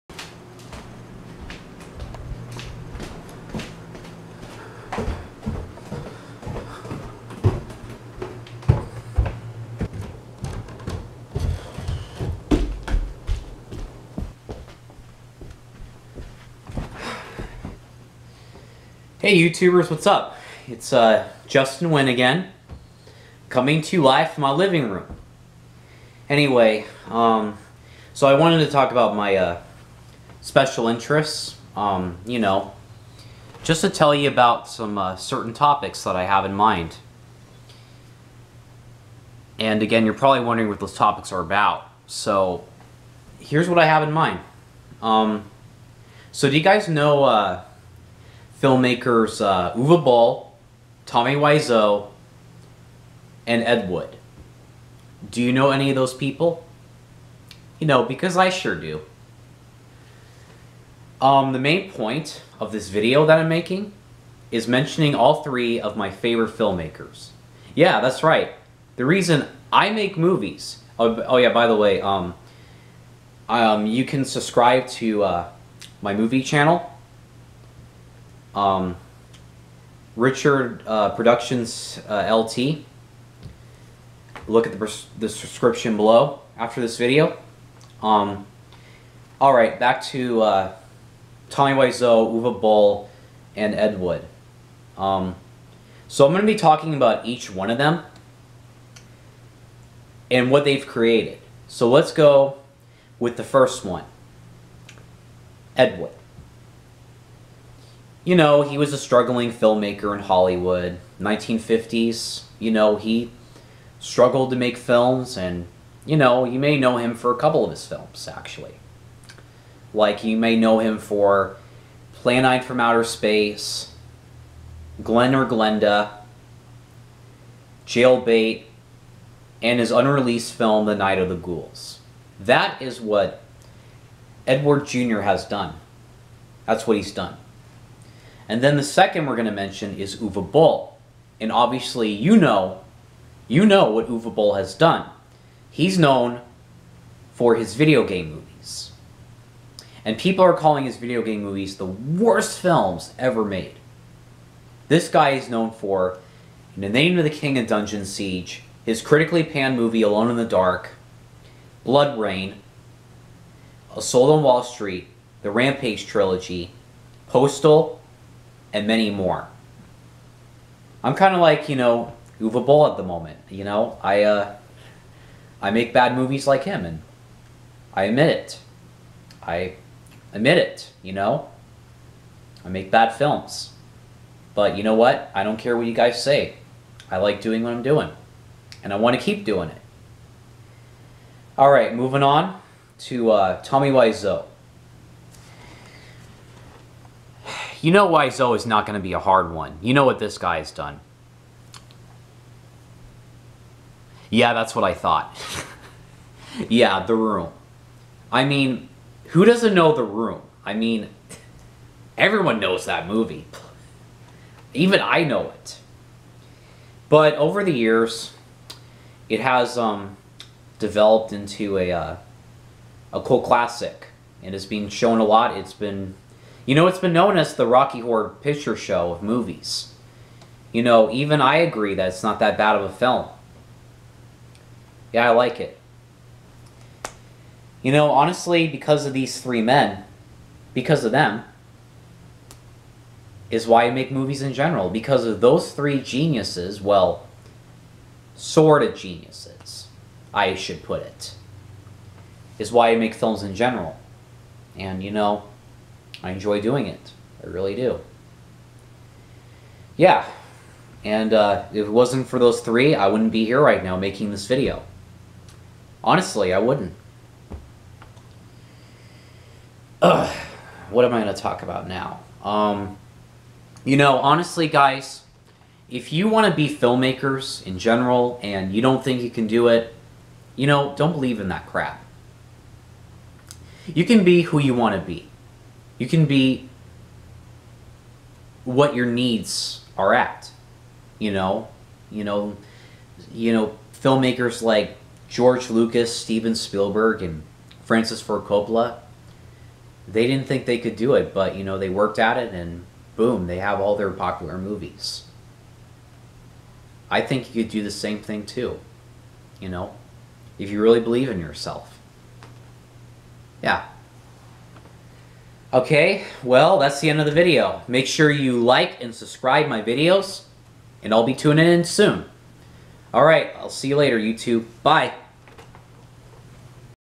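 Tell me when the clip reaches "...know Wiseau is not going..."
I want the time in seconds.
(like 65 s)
197 s.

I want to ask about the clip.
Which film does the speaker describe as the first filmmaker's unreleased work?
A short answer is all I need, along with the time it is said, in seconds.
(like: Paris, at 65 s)
The Night of the Ghouls, at 130 s.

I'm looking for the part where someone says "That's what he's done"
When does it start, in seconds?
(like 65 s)
136 s.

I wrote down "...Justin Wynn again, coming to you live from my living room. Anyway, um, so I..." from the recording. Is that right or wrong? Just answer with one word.
right.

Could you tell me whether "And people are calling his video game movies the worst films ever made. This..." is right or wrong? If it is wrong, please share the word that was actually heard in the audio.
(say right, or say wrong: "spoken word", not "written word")
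right.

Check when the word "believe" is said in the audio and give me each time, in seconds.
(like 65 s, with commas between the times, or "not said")
281 s, 310 s.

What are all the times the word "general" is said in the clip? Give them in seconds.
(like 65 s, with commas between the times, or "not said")
244 s, 253 s, 277 s.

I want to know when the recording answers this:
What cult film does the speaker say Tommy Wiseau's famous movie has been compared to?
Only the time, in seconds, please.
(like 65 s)
227 s.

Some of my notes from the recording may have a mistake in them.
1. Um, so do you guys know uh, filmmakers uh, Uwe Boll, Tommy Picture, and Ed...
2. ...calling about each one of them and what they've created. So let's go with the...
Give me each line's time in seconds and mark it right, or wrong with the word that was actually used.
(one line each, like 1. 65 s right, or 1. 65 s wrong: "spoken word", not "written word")
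1. 44 s wrong: "Wiseau", not "Picture"
2. 96 s wrong: "talking", not "calling".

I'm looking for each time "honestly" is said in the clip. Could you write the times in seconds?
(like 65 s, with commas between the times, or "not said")
238 s, 266 s, 274 s.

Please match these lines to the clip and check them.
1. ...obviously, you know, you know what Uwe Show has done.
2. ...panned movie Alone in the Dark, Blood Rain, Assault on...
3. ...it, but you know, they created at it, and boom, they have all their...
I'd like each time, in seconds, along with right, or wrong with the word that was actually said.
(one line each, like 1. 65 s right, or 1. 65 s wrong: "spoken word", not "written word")
1. 141 s wrong: "Boll", not "Show"
2. 159 s right
3. 301 s wrong: "worked", not "created".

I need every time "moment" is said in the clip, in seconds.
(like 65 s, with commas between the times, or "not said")
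173 s.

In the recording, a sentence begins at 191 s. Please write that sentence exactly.
Alright, moving on to uh, Tommy Wiseau.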